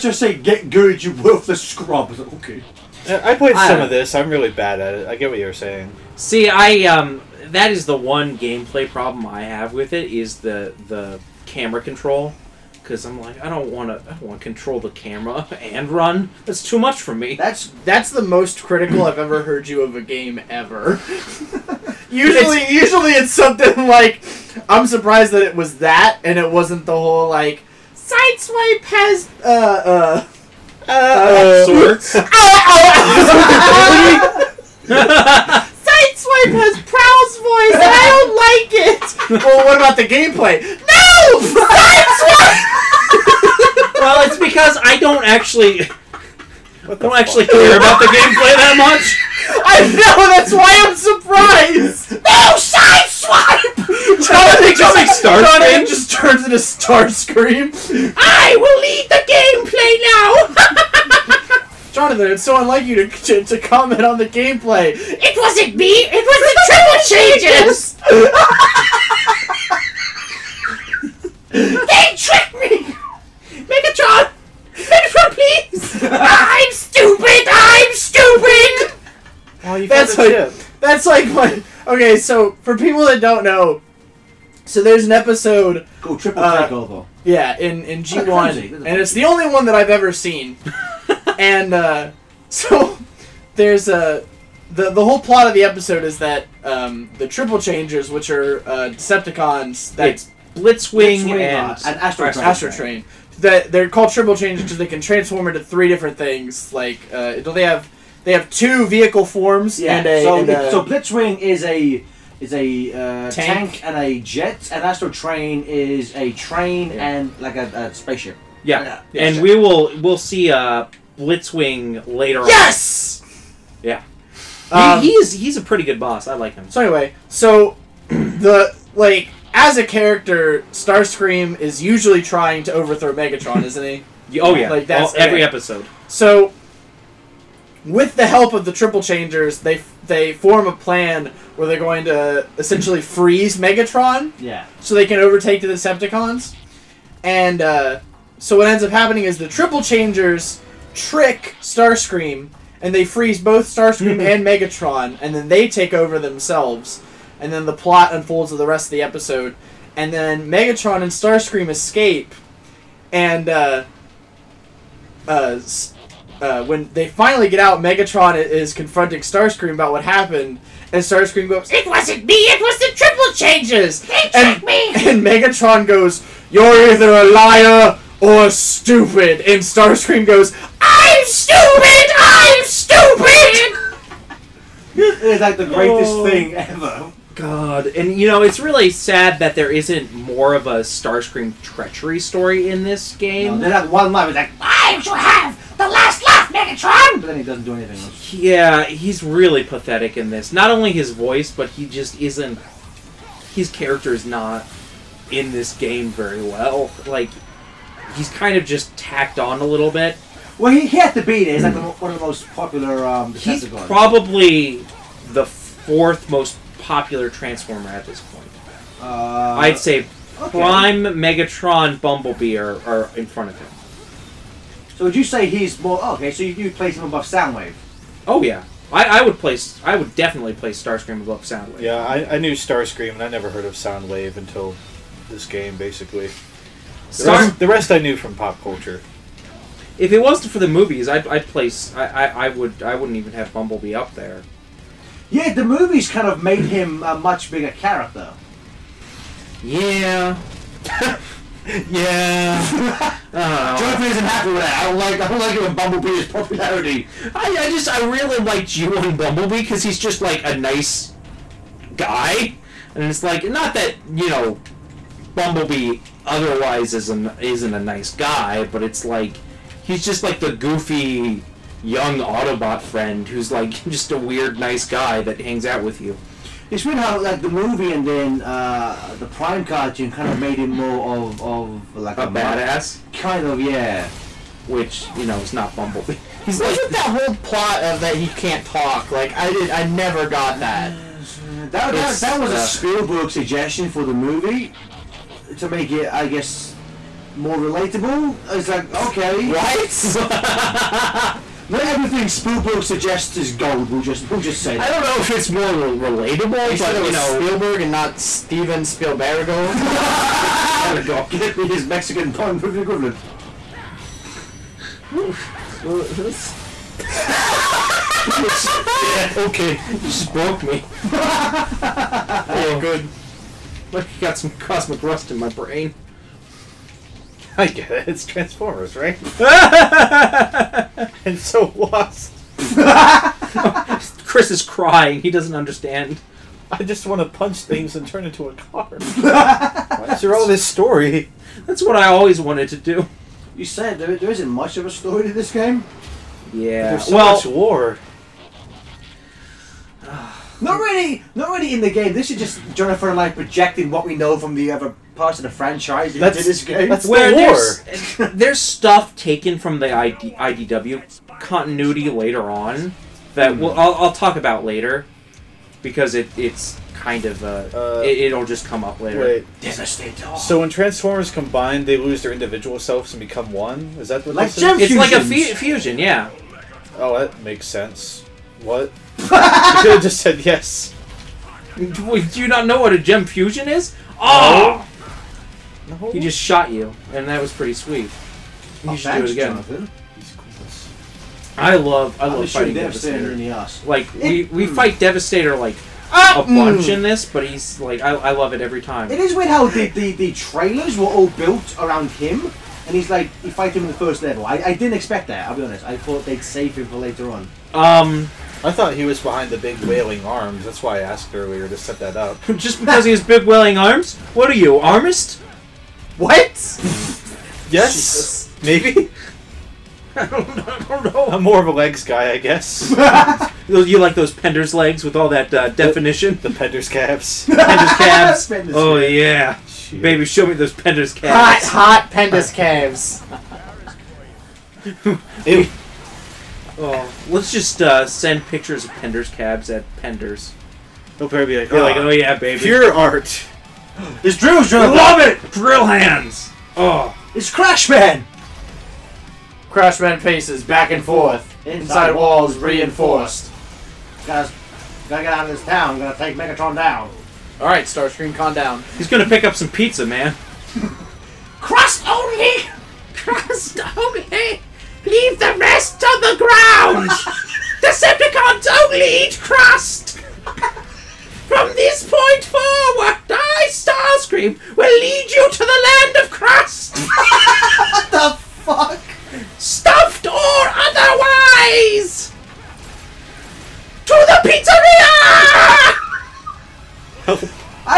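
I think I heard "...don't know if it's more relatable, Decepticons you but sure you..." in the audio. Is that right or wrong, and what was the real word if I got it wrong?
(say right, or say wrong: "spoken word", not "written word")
wrong: "Are", not "Decepticons".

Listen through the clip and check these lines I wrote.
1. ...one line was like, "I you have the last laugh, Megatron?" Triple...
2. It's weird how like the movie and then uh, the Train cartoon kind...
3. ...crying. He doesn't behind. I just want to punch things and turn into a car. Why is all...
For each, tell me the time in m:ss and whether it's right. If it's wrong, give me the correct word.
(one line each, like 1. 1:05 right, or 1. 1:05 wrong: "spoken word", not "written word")
1. 3:13 wrong: "But", not "Triple"
2. 4:36 wrong: "Prime", not "Train"
3. 5:34 wrong: "understand", not "behind".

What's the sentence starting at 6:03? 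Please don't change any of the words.
we'll, I'll, I'll, talk about later because it, it's kind of uh, it, will just come up later.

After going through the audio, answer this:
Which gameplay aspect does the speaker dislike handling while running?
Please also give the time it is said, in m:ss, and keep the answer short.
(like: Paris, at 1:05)
Camera control, at 0:11.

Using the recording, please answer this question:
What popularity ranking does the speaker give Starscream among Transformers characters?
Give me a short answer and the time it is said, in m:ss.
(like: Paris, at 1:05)
Fourth, at 3:35.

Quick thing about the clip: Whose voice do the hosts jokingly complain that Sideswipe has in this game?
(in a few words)
Prowl.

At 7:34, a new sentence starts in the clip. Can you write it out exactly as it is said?
Guys, gotta get out of this town.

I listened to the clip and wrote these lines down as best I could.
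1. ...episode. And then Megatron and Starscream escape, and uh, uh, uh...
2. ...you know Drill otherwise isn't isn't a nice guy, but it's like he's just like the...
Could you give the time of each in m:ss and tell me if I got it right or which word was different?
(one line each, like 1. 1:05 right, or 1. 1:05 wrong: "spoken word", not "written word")
1. 2:39 right
2. 4:24 wrong: "Bumblebee", not "Drill".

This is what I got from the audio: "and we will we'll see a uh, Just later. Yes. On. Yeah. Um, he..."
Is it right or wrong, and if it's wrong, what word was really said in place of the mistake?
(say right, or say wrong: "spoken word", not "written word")
wrong: "Blitzwing", not "Just".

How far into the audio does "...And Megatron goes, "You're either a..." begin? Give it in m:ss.
2:54.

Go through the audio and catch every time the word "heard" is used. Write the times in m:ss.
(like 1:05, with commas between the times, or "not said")
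0:19, 3:53.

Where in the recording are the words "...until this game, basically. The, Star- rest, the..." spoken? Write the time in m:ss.
3:54.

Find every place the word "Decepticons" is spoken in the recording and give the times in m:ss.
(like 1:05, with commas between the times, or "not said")
1:38, 2:25, 7:47.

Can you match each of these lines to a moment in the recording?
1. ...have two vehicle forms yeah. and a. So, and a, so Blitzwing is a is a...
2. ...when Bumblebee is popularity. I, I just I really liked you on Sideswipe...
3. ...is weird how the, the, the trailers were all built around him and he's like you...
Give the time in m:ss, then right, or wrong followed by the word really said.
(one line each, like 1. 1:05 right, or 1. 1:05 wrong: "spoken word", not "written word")
1. 1:48 right
2. 4:15 wrong: "Bumblebee", not "Sideswipe"
3. 6:39 right.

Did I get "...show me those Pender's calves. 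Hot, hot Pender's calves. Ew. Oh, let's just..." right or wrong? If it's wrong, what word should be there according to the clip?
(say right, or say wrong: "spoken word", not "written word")
right.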